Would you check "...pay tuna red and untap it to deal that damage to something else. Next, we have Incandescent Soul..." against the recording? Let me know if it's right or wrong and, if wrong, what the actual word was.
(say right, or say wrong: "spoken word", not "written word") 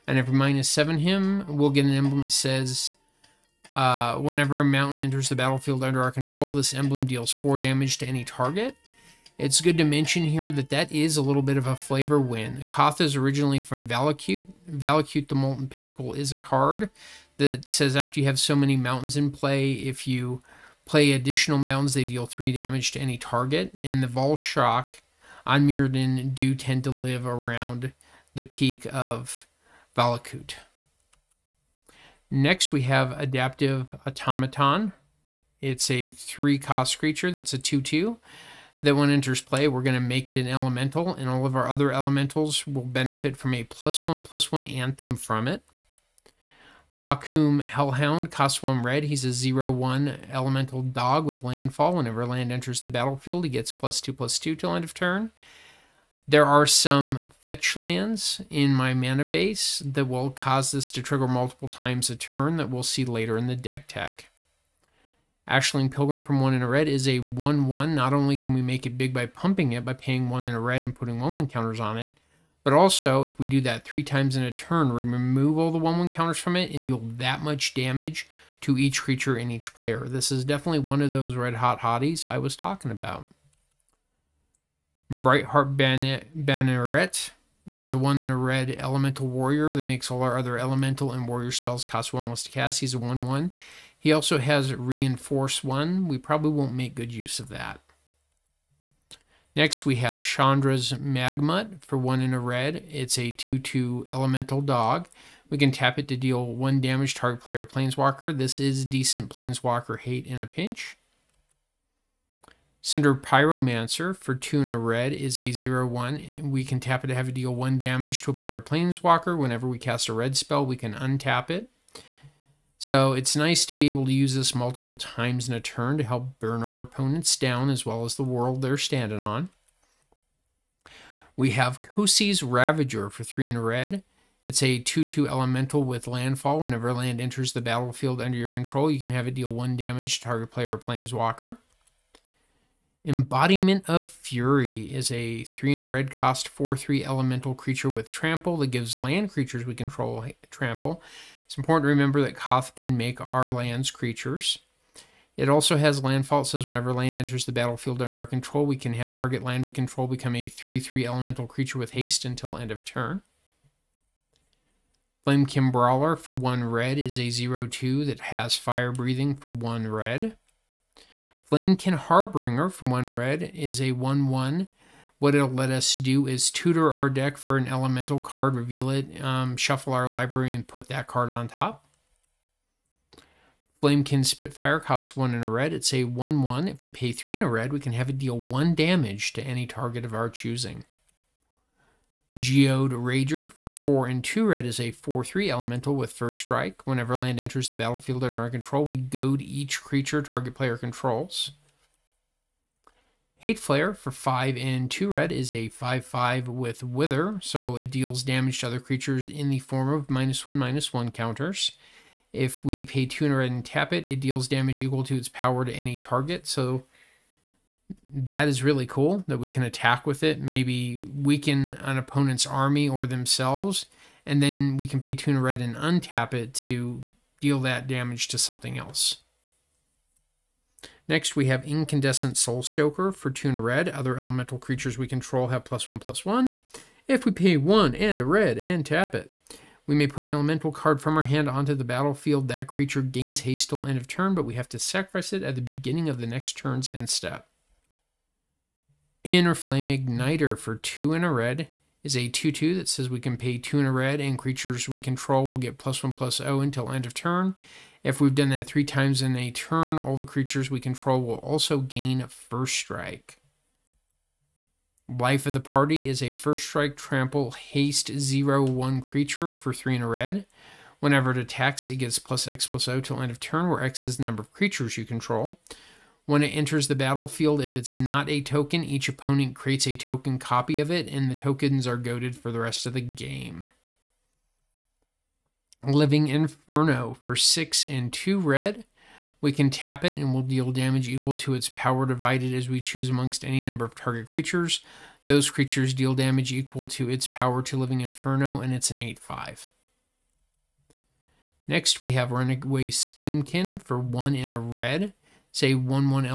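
right.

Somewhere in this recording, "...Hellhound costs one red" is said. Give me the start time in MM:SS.
00:47.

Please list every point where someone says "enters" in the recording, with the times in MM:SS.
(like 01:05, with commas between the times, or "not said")
00:04, 00:39, 00:52, 02:17, 02:37, 03:17, 04:36.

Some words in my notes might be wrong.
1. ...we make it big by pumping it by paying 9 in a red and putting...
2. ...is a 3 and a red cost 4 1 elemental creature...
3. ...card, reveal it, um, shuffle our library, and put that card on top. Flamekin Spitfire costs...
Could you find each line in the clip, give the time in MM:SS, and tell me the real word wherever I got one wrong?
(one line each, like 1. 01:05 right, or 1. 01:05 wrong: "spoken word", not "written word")
1. 01:08 wrong: "1", not "9"
2. 02:24 wrong: "3", not "1"
3. 02:58 right.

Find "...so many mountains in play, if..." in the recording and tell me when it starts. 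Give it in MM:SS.
00:18.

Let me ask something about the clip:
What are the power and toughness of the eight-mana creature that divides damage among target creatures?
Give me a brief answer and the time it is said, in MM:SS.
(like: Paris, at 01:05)
8/5, at 04:58.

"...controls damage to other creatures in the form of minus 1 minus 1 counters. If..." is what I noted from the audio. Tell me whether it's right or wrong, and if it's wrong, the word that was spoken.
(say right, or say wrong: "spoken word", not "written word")
wrong: "deals", not "controls".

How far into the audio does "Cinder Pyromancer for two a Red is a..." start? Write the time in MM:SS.
01:52.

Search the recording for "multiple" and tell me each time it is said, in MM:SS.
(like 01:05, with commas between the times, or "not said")
01:01, 02:04.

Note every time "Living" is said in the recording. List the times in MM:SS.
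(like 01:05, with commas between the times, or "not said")
04:45, 04:57.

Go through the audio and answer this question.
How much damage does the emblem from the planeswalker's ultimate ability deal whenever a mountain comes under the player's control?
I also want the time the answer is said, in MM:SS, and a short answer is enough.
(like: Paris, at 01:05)
4, at 00:07.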